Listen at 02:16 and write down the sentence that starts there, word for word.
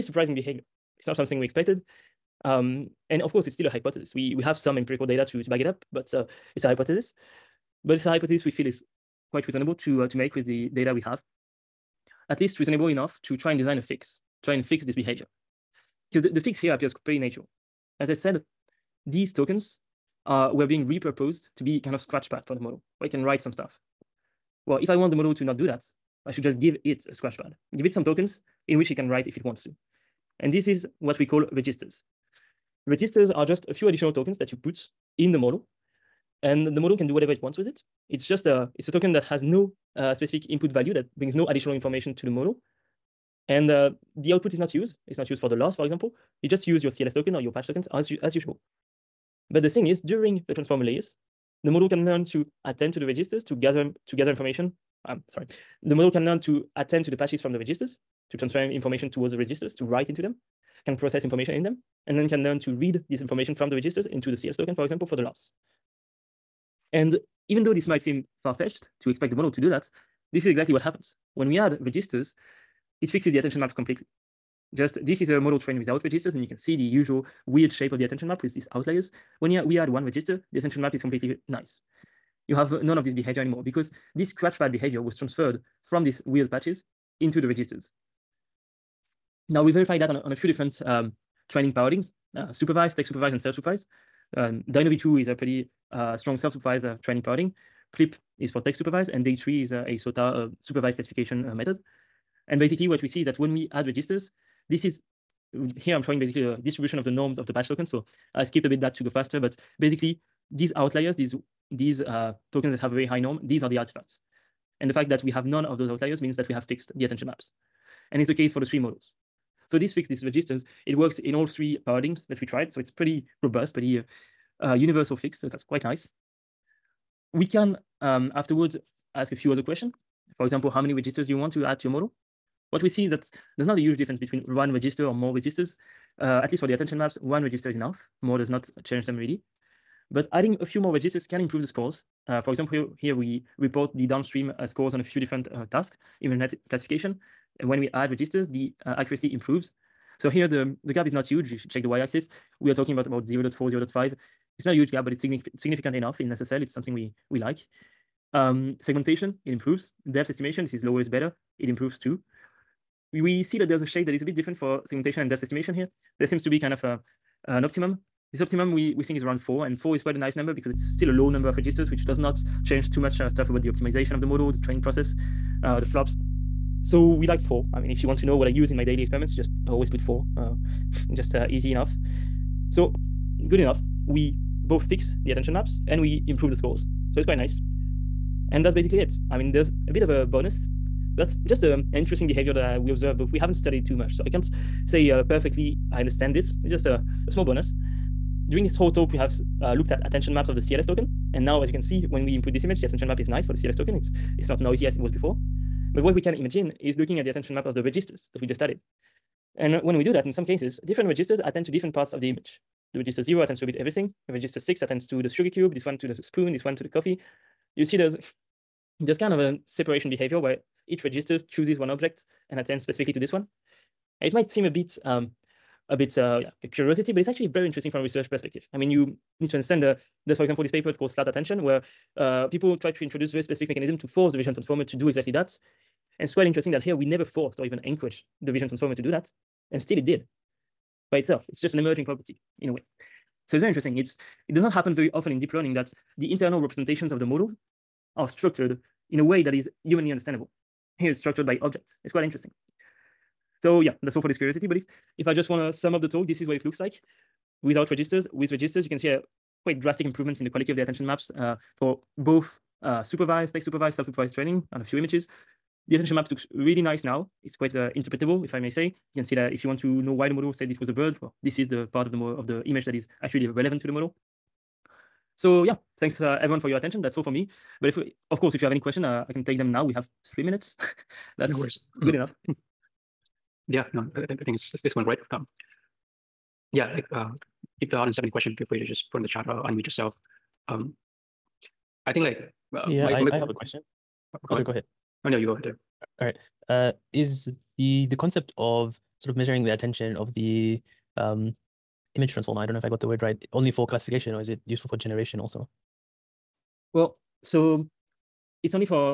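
Uh, at least for the attention maps, one register is enough.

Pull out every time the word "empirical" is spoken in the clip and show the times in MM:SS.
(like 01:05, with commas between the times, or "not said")
00:04.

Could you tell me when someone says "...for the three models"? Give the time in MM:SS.
01:58.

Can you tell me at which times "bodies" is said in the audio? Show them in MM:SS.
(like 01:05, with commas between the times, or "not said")
not said.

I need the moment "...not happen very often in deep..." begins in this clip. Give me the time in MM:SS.
04:04.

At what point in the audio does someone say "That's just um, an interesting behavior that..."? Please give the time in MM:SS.
03:11.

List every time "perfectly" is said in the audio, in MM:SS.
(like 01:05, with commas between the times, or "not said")
03:15.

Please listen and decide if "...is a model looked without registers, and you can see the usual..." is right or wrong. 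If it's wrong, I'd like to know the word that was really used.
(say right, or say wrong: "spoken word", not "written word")
wrong: "trained", not "looked".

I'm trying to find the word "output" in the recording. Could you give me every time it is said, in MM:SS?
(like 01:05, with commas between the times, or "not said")
00:44.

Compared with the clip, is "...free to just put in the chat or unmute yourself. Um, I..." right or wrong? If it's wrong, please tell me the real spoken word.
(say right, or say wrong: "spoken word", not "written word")
right.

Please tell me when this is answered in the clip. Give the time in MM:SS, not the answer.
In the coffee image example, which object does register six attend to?
03:35.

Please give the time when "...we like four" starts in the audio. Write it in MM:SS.
02:57.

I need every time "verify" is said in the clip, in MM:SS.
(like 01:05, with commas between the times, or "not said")
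01:29.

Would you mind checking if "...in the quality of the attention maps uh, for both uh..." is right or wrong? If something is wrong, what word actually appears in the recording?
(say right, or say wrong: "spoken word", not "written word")
right.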